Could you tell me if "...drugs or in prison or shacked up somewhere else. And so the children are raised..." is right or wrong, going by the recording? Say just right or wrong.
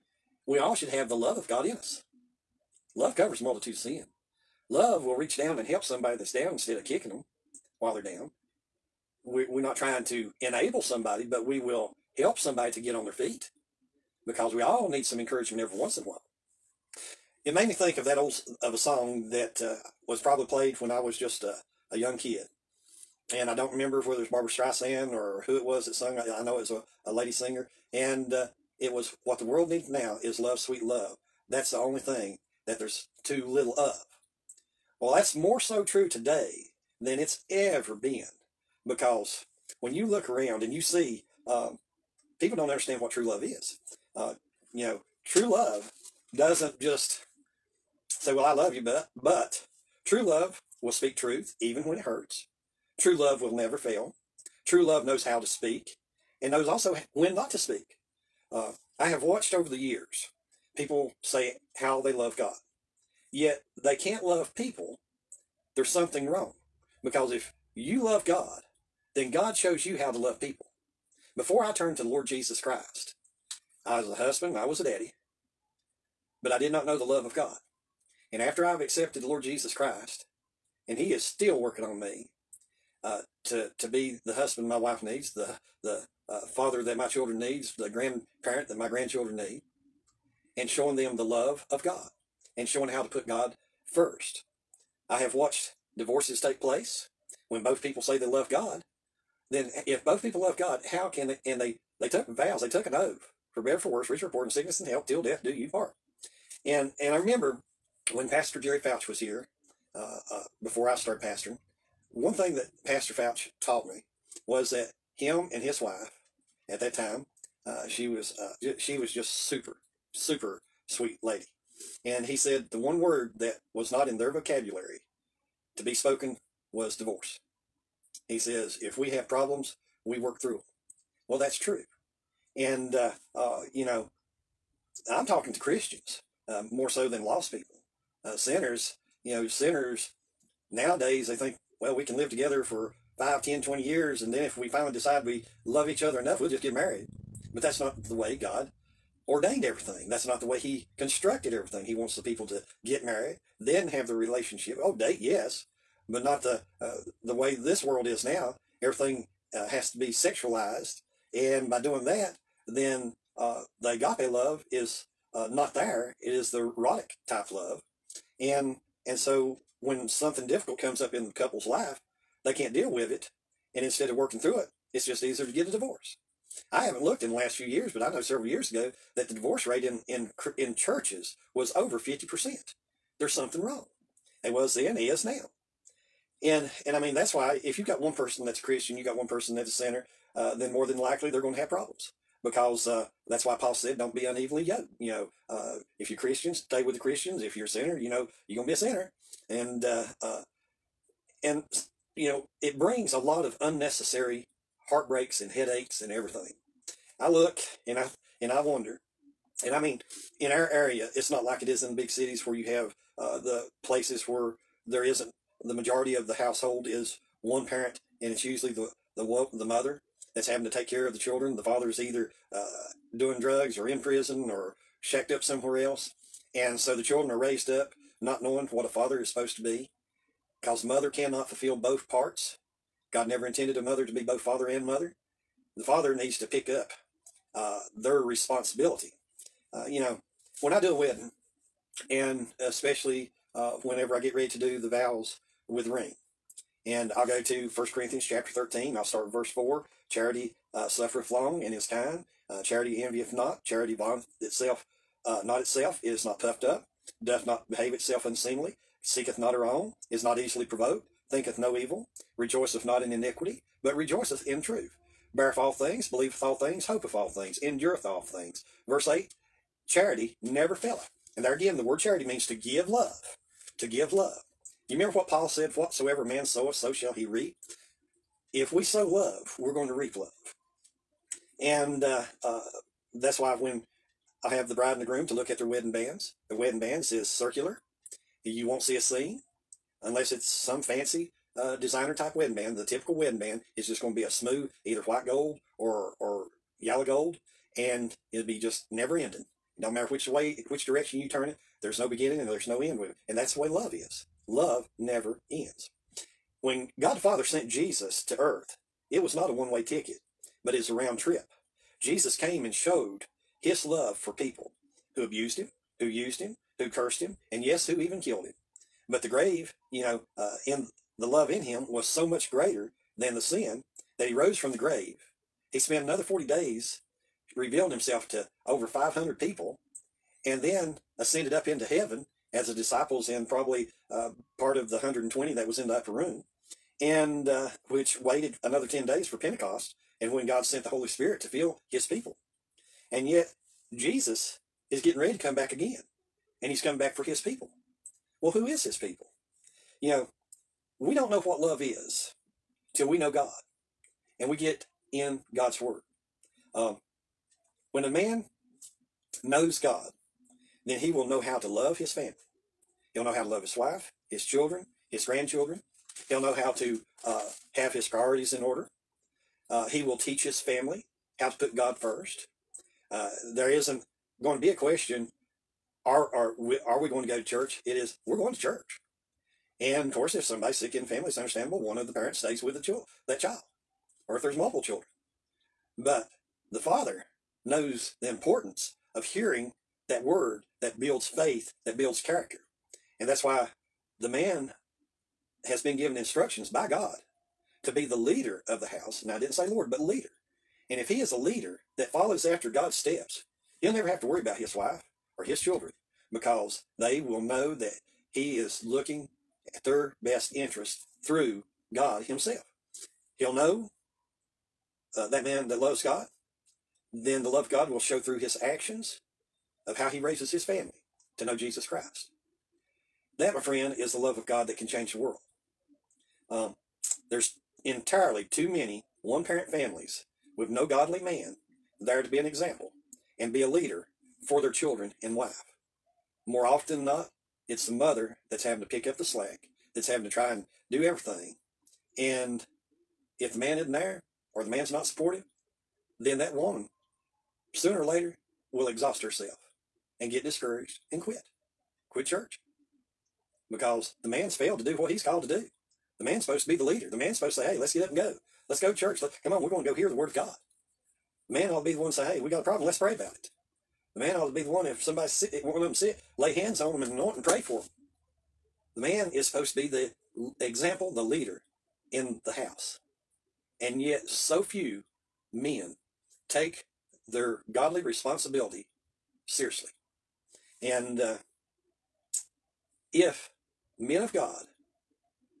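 right.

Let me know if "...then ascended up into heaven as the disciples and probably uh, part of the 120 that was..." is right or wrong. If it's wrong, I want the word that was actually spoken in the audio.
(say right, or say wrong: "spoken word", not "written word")
right.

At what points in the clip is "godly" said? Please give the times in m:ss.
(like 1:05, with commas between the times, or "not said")
7:10, 7:57.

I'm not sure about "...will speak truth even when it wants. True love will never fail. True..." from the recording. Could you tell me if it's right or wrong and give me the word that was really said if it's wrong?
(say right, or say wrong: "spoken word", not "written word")
wrong: "hurts", not "wants".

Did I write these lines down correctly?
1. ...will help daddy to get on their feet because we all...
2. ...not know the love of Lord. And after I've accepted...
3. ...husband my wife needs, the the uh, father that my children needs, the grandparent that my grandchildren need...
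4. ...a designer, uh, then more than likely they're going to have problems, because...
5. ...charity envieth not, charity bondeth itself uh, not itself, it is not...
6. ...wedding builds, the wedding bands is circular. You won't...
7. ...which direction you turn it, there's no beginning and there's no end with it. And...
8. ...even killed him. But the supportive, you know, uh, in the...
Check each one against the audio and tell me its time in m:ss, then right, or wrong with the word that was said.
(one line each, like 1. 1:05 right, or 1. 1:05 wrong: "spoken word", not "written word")
1. 0:11 wrong: "somebody", not "daddy"
2. 1:16 wrong: "God", not "Lord"
3. 1:24 right
4. 3:09 wrong: "sinner", not "designer"
5. 4:12 right
6. 4:45 wrong: "bands", not "builds"
7. 5:00 right
8. 5:17 wrong: "grave", not "supportive".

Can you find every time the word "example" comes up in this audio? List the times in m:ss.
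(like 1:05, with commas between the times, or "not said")
7:12, 7:50.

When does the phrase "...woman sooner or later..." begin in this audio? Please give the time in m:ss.
7:26.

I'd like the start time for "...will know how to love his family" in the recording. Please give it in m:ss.
6:01.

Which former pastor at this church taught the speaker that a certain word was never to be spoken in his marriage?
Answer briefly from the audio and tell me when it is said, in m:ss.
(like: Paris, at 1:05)
Jerry Fouch, at 1:48.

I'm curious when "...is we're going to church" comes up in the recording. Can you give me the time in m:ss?
6:17.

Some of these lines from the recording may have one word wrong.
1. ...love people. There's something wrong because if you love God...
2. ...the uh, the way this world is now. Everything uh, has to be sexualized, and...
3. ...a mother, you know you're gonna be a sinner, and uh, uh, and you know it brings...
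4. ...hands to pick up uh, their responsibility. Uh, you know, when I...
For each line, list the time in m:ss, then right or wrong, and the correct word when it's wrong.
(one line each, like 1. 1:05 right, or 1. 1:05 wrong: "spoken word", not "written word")
1. 1:04 right
2. 2:36 right
3. 3:17 wrong: "sinner", not "mother"
4. 3:56 wrong: "needs", not "hands".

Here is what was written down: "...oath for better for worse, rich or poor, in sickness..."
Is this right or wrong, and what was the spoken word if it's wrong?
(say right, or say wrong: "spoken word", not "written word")
right.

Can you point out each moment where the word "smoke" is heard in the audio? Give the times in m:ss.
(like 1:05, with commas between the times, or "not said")
not said.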